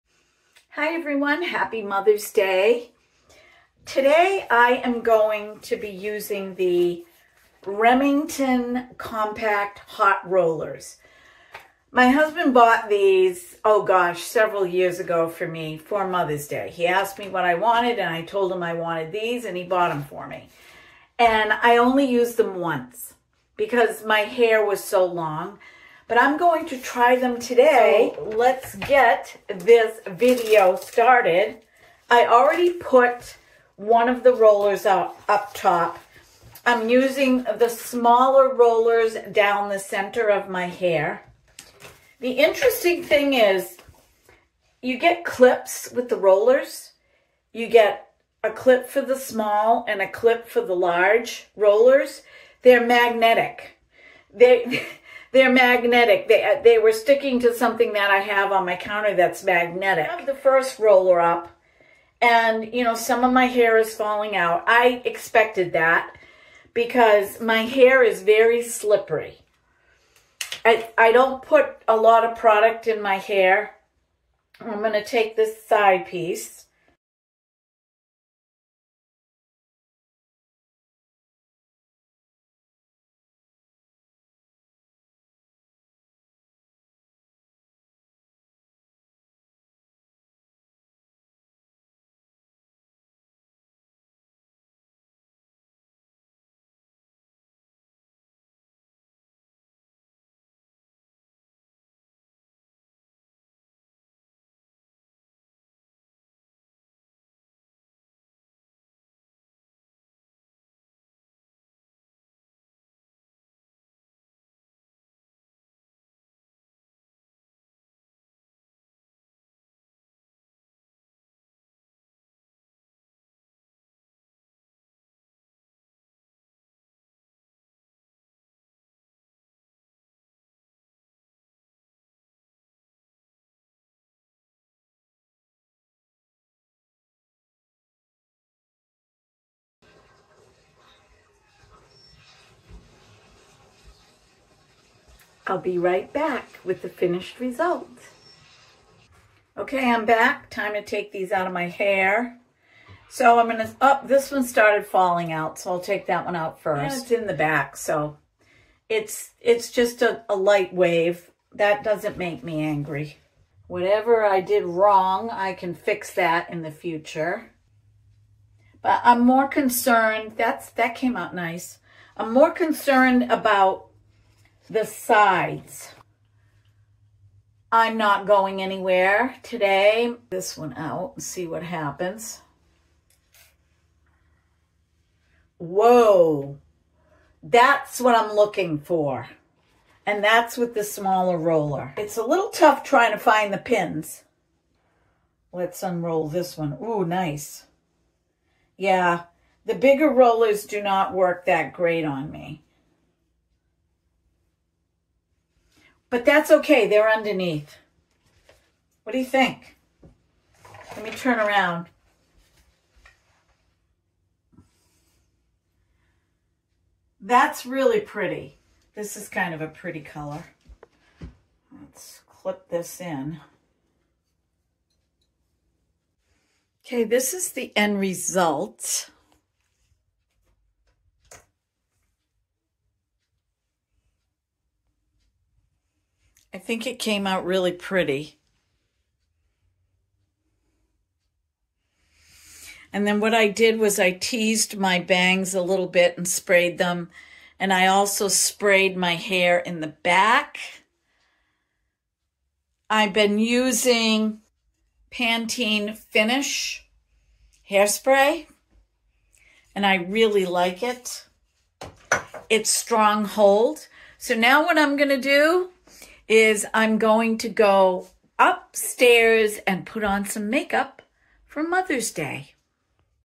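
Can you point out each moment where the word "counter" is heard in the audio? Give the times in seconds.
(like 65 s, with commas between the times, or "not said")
58 s.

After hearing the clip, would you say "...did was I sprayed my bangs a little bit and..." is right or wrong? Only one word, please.
wrong.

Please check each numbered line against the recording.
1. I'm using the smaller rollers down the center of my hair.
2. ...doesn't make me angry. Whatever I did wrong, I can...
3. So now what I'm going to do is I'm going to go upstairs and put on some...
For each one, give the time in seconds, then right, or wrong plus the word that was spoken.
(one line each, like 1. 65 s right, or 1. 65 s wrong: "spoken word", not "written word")
1. 36 s right
2. 161 s right
3. 264 s right.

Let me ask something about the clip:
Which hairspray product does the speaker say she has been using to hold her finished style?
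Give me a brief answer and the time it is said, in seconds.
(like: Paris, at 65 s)
Pantene Finish, at 255 s.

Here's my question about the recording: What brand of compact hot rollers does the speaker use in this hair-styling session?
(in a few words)
Remington.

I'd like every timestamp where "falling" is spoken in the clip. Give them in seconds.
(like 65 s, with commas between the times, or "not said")
63 s, 154 s.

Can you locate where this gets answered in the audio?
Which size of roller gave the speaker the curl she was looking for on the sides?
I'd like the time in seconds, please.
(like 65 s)
190 s.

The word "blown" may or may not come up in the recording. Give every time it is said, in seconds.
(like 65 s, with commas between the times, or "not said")
not said.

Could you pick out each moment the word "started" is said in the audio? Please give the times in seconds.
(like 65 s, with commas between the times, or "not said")
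30 s, 154 s.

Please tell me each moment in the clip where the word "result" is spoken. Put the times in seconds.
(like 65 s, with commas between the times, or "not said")
147 s, 228 s.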